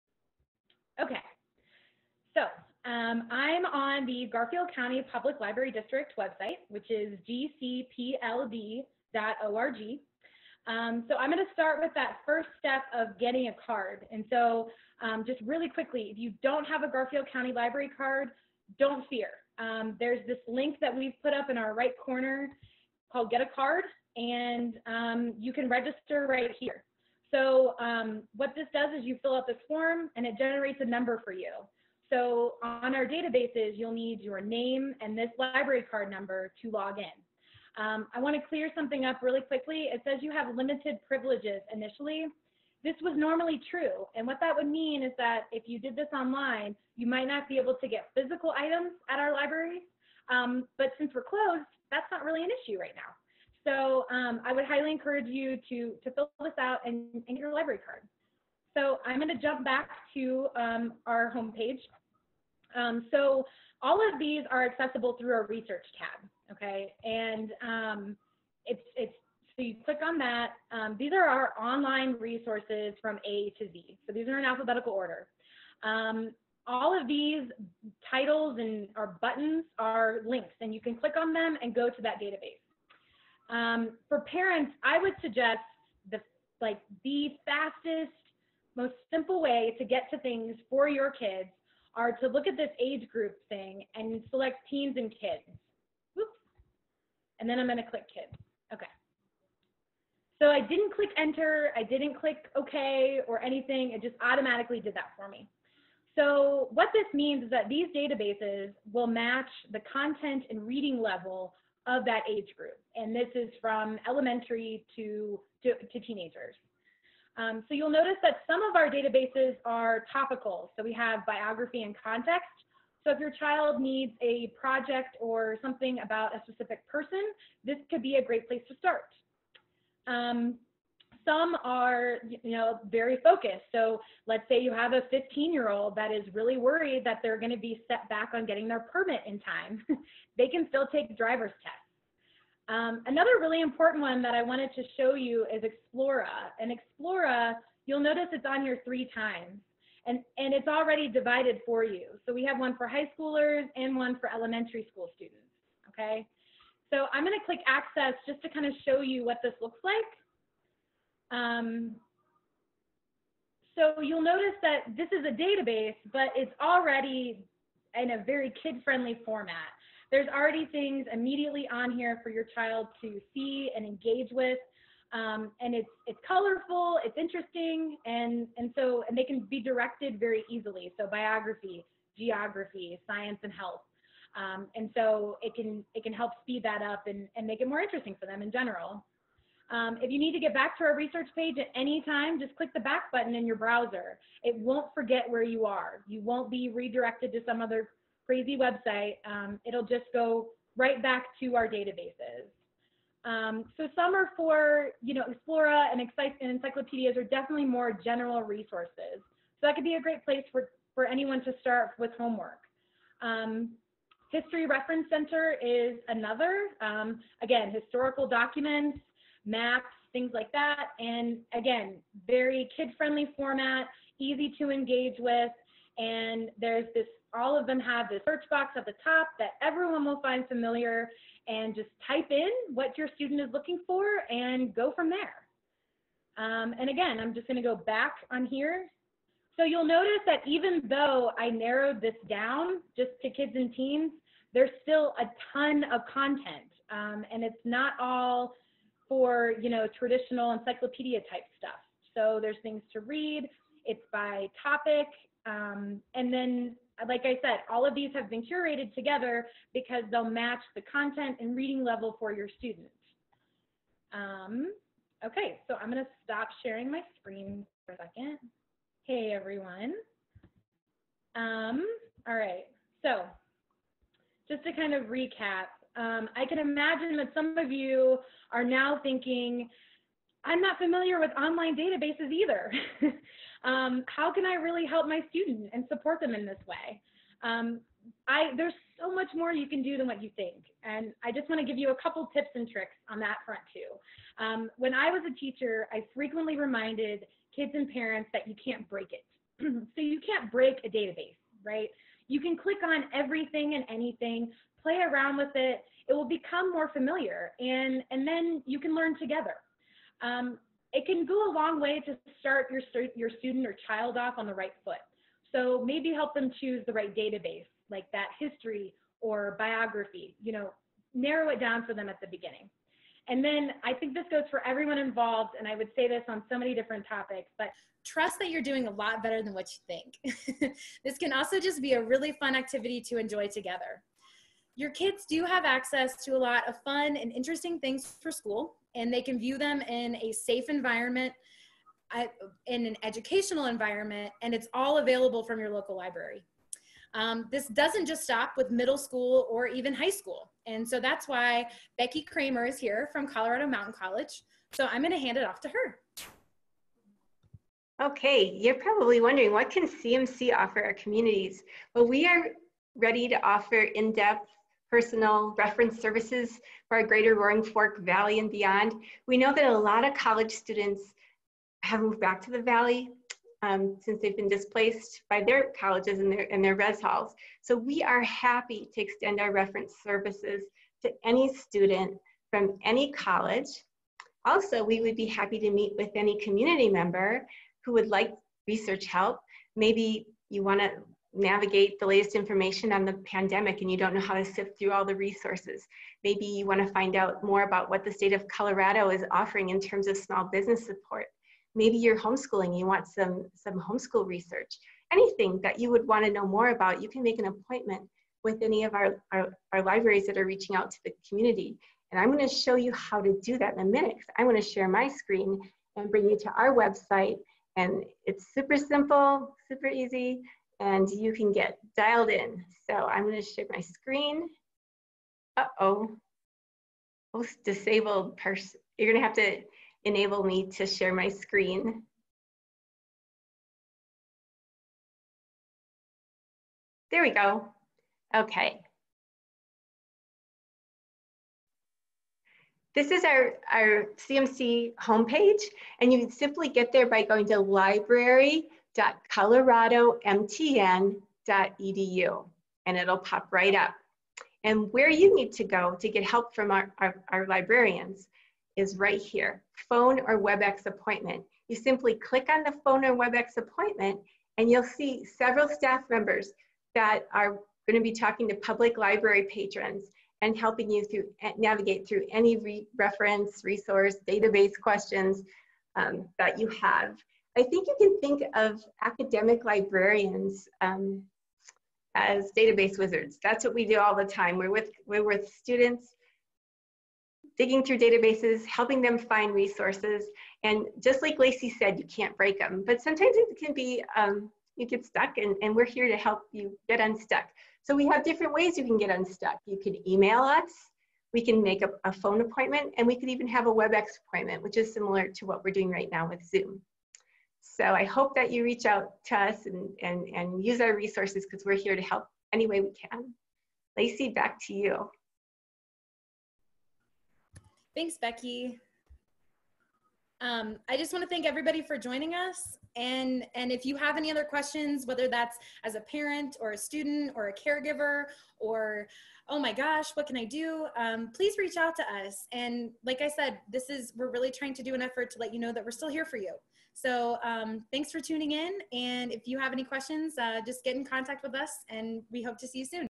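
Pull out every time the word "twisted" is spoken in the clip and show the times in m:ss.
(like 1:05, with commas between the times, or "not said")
not said.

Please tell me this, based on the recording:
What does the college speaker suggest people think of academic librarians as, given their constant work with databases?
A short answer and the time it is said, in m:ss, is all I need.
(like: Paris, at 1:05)
database wizards, at 8:02.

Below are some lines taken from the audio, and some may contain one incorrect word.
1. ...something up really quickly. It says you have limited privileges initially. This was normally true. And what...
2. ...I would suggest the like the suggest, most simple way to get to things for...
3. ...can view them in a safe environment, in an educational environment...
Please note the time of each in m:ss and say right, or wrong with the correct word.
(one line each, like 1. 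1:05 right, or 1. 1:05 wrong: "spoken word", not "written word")
1. 0:38 right
2. 1:24 wrong: "fastest", not "suggest"
3. 5:39 right.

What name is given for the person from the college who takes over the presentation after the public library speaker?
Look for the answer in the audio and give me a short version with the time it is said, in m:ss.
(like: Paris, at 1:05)
Becky Kramer, at 5:51.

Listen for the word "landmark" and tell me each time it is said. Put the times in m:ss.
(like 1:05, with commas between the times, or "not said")
not said.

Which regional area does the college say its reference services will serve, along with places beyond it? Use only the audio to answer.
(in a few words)
Roaring Fork Valley.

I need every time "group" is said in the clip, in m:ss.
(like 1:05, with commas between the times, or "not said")
1:33, 1:52.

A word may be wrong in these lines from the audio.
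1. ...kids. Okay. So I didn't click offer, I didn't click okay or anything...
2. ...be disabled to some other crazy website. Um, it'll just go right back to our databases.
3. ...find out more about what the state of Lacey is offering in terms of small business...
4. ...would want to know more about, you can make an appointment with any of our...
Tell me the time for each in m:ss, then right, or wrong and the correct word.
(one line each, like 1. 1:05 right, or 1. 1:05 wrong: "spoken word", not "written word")
1. 1:38 wrong: "enter", not "offer"
2. 3:16 wrong: "redirected", not "disabled"
3. 6:36 wrong: "Colorado", not "Lacey"
4. 6:45 right.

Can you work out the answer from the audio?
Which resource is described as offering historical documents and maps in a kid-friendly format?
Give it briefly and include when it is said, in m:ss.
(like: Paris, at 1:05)
History Reference Center, at 3:34.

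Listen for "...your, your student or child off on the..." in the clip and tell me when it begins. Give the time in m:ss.
5:12.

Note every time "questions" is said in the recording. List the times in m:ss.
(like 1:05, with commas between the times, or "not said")
7:54, 8:44, 8:59.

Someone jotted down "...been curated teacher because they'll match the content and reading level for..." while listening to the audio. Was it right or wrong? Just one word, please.
wrong.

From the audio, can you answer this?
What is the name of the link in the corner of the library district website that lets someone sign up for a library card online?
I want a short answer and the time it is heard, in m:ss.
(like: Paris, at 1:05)
Get a Card, at 0:23.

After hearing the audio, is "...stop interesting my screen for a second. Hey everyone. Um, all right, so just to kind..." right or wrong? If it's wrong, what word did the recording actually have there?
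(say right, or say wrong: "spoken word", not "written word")
wrong: "sharing", not "interesting".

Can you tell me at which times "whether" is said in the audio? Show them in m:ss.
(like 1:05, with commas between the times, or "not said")
8:45.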